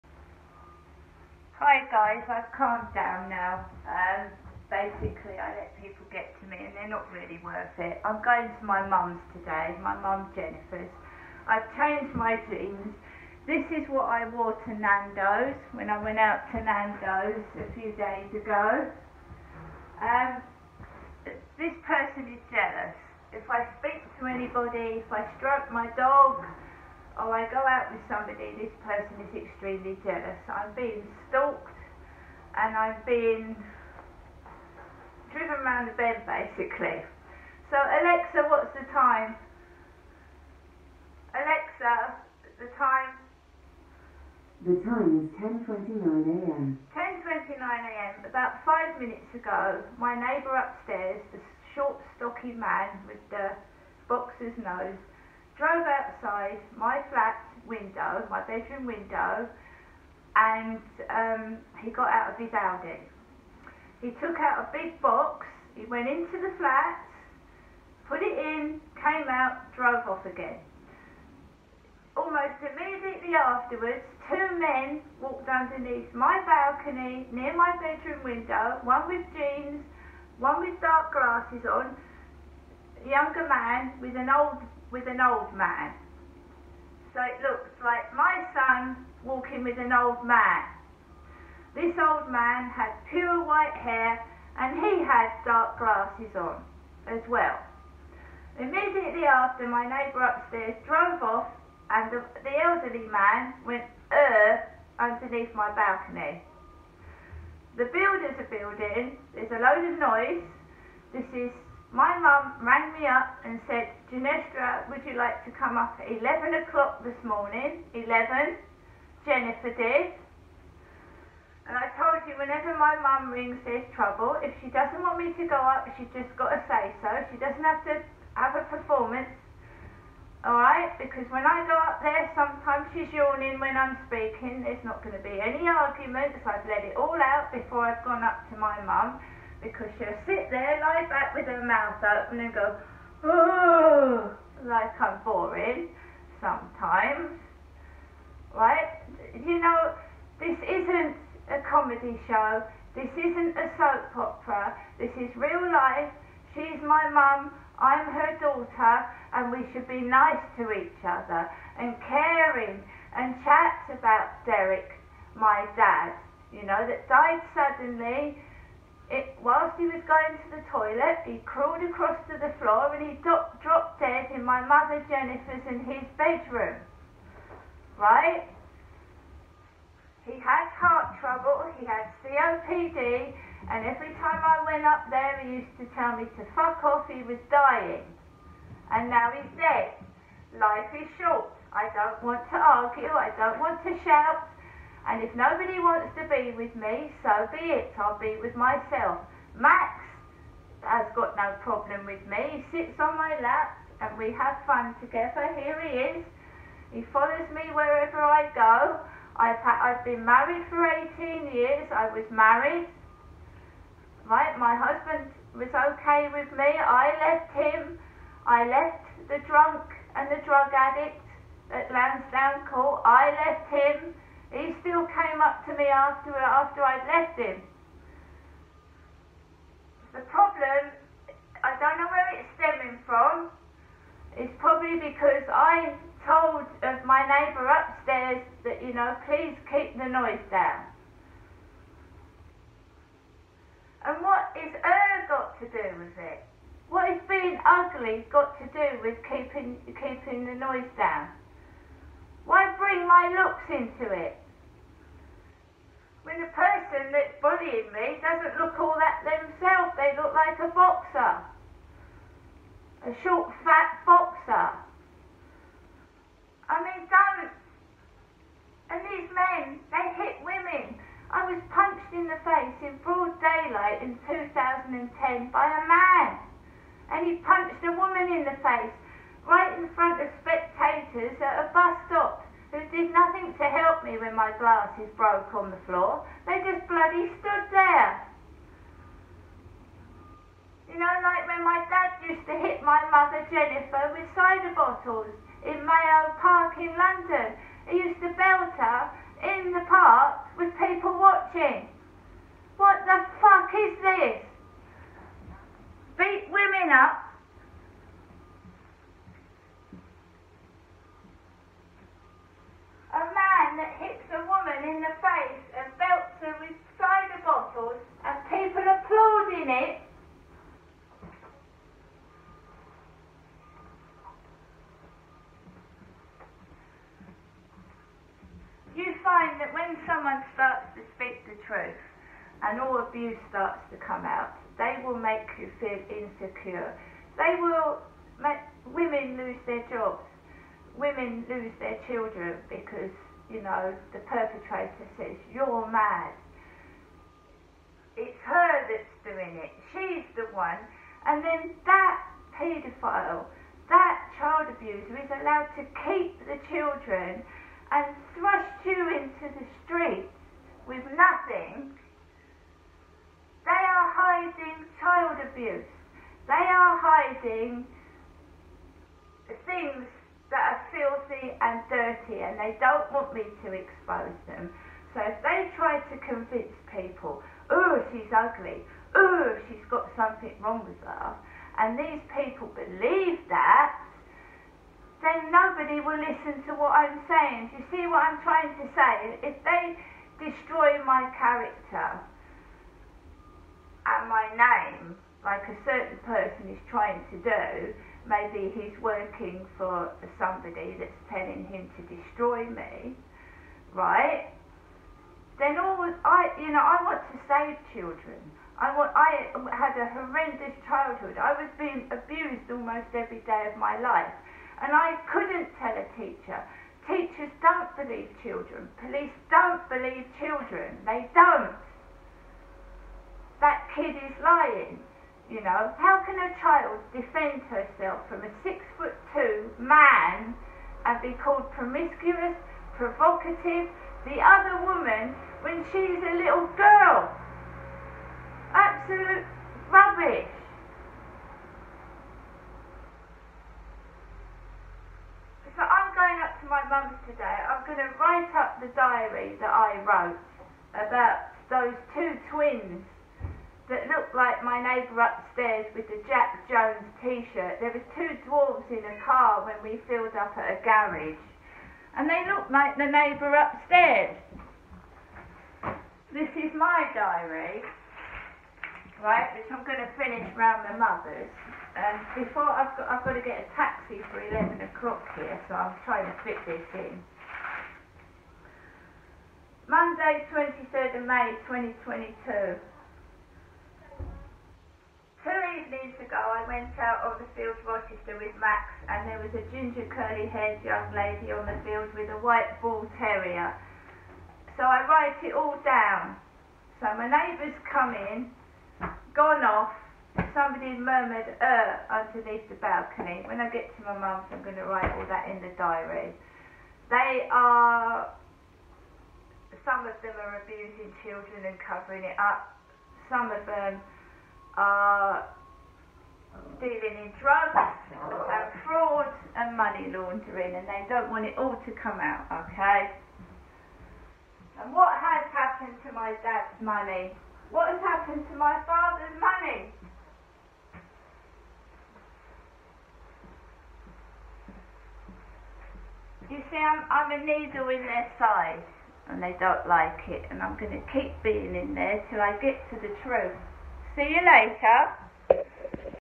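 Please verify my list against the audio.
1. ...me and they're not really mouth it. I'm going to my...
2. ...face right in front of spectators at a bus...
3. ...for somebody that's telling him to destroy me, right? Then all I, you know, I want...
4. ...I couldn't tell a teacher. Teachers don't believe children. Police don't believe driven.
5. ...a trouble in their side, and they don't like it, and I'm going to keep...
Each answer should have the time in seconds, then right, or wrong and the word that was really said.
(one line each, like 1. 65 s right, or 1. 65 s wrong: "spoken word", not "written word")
1. 6 s wrong: "worth", not "mouth"
2. 278 s right
3. 399 s right
4. 414 s wrong: "children", not "driven"
5. 537 s wrong: "needle", not "trouble".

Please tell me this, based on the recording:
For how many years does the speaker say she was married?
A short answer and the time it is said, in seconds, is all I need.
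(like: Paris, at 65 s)
18, at 210 s.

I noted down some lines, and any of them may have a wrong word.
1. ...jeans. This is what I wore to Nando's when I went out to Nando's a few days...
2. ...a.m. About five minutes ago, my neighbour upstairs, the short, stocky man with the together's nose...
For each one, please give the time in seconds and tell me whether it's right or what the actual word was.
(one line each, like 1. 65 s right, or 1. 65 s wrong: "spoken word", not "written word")
1. 12 s right
2. 47 s wrong: "boxer", not "together".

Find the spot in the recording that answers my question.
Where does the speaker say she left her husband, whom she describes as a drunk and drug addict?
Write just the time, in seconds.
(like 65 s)
221 s.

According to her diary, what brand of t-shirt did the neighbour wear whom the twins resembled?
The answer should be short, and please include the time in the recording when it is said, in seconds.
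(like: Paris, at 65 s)
Jack Jones, at 456 s.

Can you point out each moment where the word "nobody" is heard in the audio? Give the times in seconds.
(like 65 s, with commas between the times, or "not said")
195 s, 385 s.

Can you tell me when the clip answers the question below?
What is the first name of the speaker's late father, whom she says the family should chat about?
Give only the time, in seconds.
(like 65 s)
164 s.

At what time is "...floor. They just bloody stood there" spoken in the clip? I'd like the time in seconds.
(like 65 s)
285 s.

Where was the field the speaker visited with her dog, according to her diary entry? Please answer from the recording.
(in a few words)
Rochester.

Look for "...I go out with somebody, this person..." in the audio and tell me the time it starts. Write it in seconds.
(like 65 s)
27 s.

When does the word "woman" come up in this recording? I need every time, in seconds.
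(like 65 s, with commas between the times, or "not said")
277 s, 434 s.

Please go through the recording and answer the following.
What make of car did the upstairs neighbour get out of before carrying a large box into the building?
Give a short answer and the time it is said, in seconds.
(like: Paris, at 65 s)
Audi, at 62 s.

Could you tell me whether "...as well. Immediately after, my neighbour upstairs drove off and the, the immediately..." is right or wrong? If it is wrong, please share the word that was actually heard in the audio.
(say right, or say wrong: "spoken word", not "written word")
wrong: "elderly", not "immediately".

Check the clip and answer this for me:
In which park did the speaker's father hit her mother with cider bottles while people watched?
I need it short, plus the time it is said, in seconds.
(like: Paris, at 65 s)
Mayo Park, at 295 s.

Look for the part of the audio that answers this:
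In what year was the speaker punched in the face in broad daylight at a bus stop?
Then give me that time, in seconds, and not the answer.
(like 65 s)
274 s.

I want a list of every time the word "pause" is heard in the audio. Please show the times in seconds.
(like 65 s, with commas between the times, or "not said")
not said.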